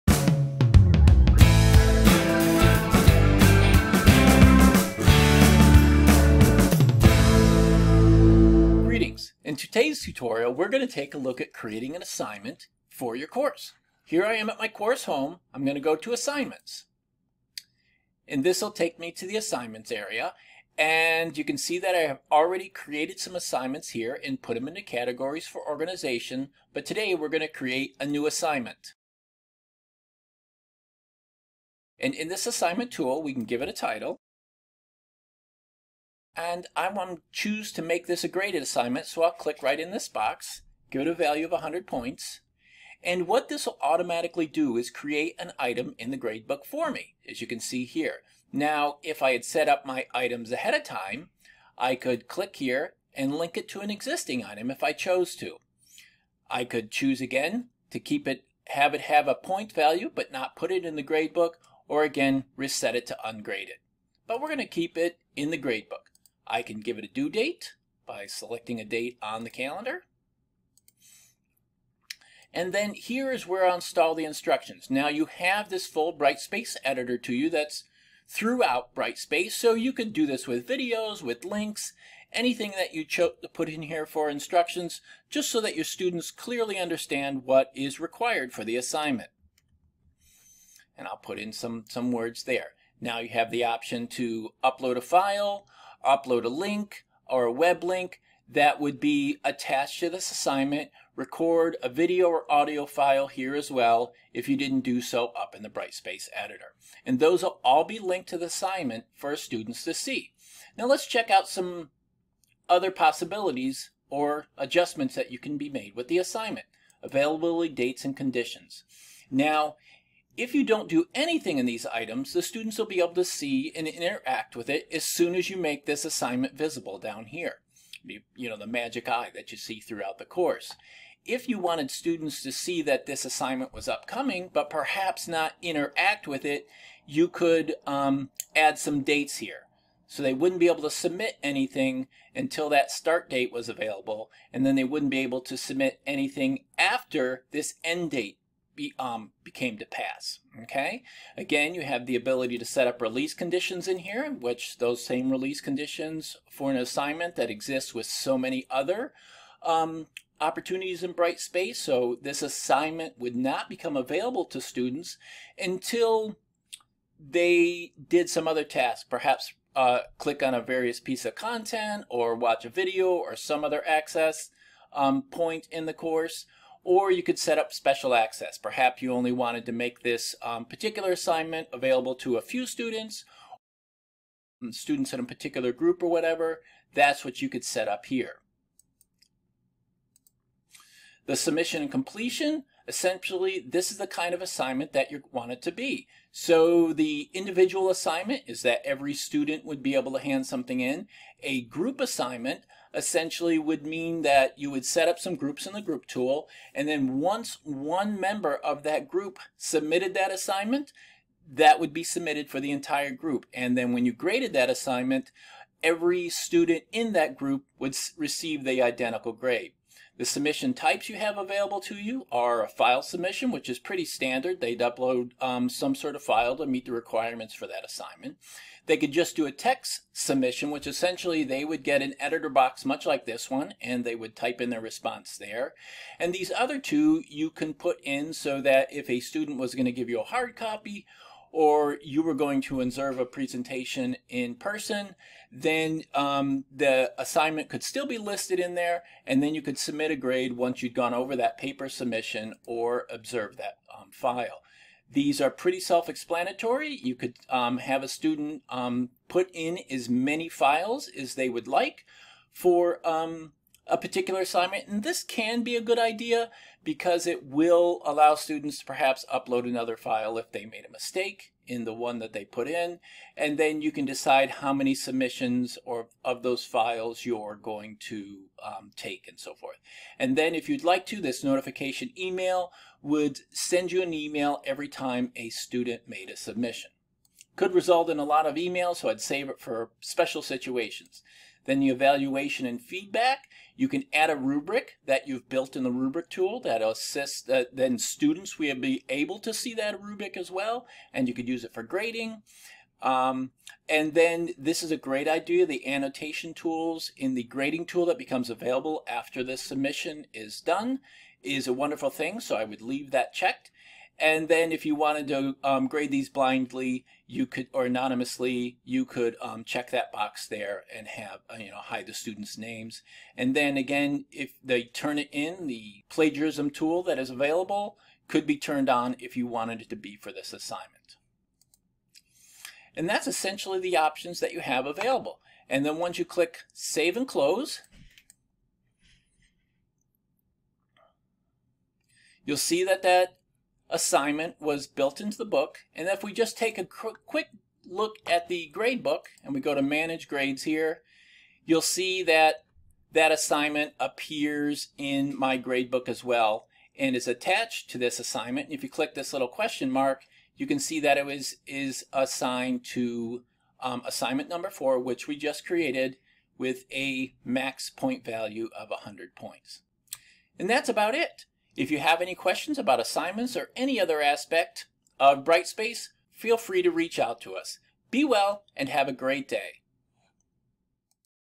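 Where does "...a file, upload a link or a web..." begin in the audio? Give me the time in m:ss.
1:34.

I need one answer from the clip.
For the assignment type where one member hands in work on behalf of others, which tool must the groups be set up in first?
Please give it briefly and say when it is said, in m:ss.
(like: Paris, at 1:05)
the group tool, at 3:25.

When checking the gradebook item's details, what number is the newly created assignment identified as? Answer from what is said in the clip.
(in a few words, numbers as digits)
4.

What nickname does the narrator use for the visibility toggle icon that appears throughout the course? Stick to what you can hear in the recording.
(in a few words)
the magic eye.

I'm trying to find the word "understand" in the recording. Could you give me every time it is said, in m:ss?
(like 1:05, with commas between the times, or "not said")
1:26.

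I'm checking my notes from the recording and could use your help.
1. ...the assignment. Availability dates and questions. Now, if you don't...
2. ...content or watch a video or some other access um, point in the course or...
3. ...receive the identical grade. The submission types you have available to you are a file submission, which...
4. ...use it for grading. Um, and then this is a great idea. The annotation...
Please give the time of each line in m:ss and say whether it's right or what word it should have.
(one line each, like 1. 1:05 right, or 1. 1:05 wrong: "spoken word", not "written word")
1. 1:56 wrong: "conditions", not "questions"
2. 2:51 right
3. 3:38 right
4. 5:01 right.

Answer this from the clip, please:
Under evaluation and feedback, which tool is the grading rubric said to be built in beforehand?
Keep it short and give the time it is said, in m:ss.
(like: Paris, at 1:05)
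the rubric tool, at 4:55.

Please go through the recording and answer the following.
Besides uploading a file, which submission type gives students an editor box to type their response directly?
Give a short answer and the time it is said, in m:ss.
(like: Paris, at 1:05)
text submission, at 3:49.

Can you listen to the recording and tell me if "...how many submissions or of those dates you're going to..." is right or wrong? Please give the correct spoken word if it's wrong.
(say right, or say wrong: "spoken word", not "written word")
wrong: "files", not "dates".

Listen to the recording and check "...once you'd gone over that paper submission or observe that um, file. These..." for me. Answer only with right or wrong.
right.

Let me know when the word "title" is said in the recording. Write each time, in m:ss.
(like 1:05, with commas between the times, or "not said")
0:33.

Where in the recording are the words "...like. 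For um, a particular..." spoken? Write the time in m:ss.
4:21.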